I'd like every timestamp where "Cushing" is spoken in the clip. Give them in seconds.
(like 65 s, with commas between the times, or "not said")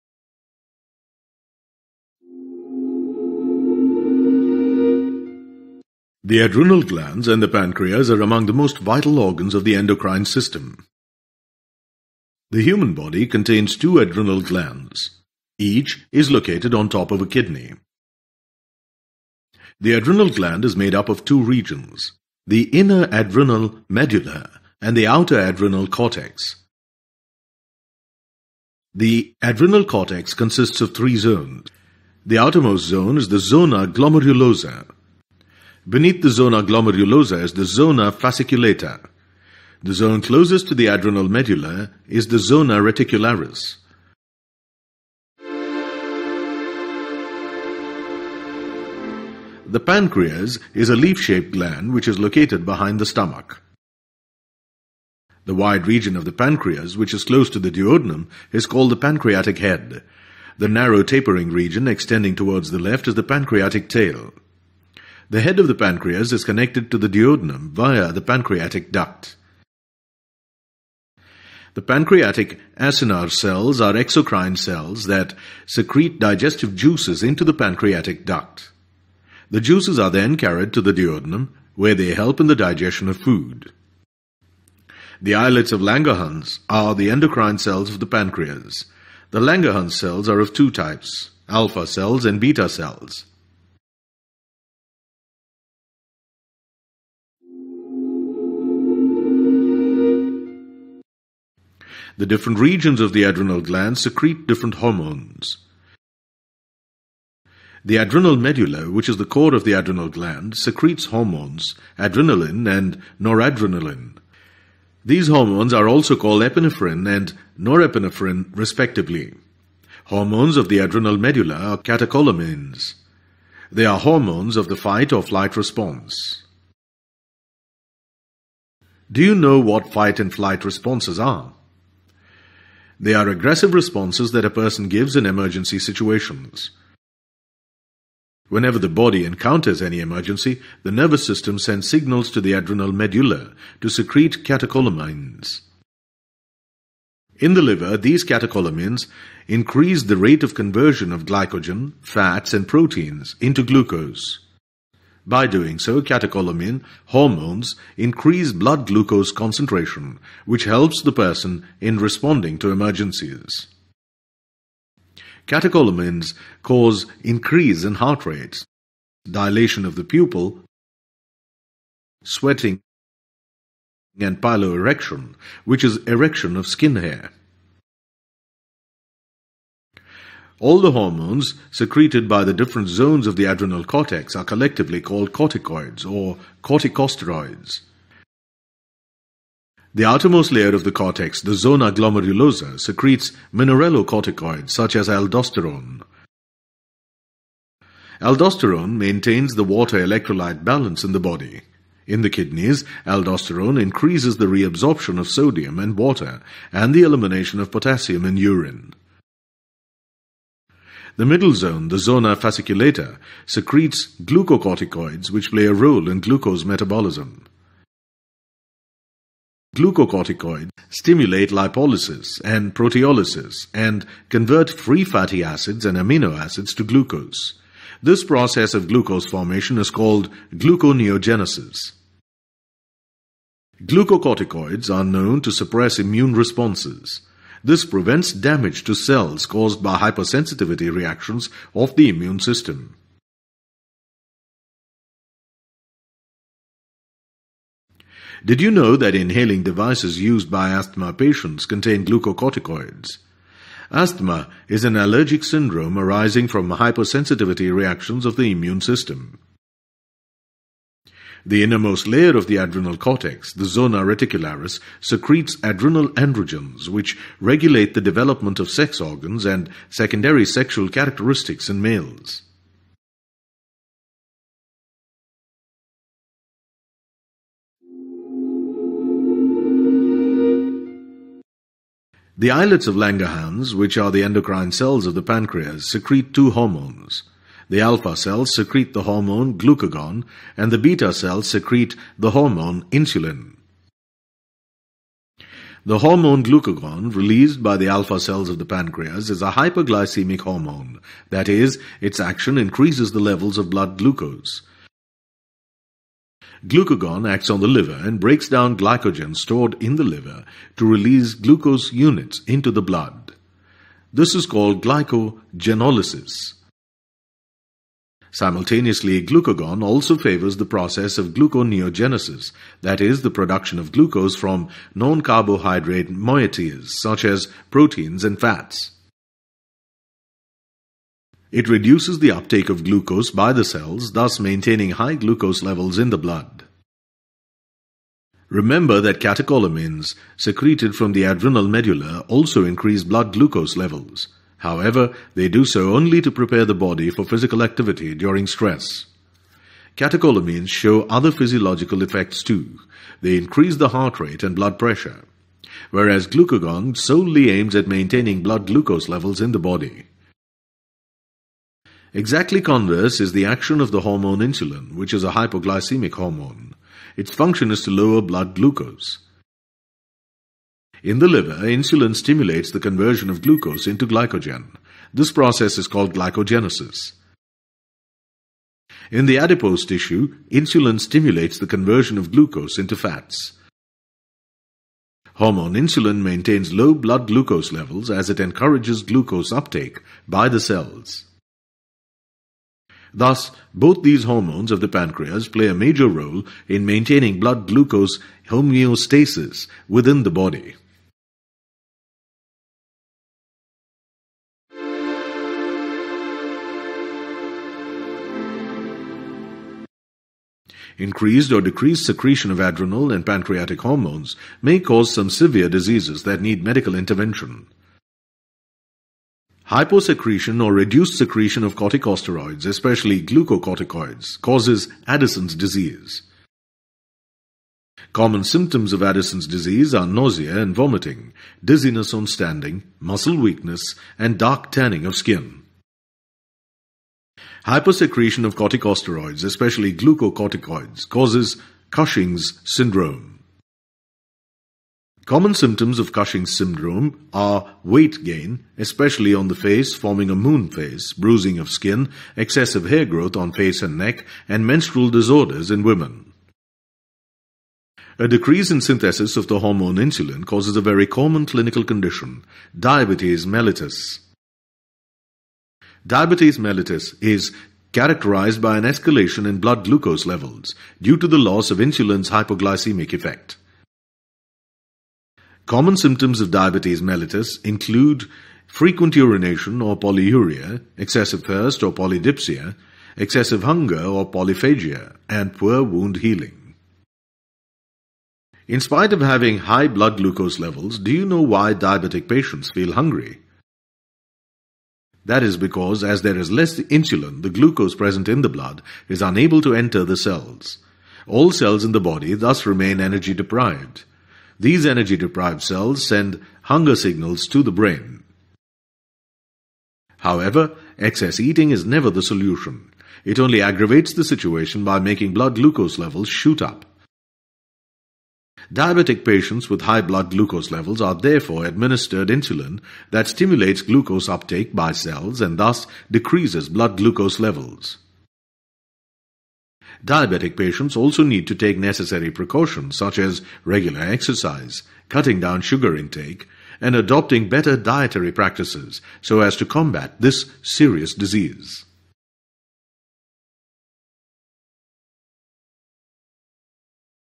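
441 s, 446 s.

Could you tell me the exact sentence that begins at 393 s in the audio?
Thus, both these hormones of the pancreas play a major role in maintaining blood glucose homeostasis within the body.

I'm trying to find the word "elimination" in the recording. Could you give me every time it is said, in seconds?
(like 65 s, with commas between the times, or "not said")
207 s.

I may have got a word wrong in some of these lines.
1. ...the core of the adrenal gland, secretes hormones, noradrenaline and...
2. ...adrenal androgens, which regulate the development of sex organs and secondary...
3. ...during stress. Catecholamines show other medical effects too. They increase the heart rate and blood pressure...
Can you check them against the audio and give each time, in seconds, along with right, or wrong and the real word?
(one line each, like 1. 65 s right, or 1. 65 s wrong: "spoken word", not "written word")
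1. 109 s wrong: "adrenaline", not "noradrenaline"
2. 265 s right
3. 348 s wrong: "physiological", not "medical".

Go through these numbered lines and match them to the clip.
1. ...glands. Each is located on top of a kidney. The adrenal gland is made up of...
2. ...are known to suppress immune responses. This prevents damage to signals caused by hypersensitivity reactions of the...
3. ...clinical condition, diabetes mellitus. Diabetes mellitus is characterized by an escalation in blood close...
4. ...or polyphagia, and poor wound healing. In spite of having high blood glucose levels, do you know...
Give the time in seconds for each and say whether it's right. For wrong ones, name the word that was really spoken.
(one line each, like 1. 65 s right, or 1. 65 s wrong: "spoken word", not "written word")
1. 14 s right
2. 234 s wrong: "cells", not "signals"
3. 461 s wrong: "glucose", not "close"
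4. 484 s right.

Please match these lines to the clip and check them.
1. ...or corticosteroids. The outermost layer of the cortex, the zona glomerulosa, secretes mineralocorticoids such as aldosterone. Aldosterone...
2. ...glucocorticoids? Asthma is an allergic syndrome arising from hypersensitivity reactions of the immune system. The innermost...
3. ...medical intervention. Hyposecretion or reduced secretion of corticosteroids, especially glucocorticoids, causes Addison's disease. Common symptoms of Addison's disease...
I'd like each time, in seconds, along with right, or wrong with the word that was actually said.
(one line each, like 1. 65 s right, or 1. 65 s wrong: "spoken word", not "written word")
1. 186 s right
2. 252 s right
3. 416 s right.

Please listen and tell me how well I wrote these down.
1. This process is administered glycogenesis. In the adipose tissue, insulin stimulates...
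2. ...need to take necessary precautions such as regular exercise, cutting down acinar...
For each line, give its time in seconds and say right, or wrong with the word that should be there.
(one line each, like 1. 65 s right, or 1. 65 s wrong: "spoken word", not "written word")
1. 375 s wrong: "called", not "administered"
2. 531 s wrong: "sugar", not "acinar".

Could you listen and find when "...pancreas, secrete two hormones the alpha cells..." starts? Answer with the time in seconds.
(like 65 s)
285 s.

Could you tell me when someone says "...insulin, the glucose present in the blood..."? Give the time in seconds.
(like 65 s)
496 s.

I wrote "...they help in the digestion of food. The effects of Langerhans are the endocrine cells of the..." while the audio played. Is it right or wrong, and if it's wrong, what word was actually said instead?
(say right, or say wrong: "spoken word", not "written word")
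wrong: "islets", not "effects".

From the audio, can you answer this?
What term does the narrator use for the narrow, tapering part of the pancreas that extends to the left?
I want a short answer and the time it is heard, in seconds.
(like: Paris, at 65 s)
pancreatic tail, at 63 s.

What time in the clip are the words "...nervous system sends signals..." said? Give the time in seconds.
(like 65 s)
140 s.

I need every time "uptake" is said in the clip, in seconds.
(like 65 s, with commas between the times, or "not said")
332 s, 389 s, 524 s.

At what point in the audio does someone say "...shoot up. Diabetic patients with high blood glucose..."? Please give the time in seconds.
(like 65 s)
516 s.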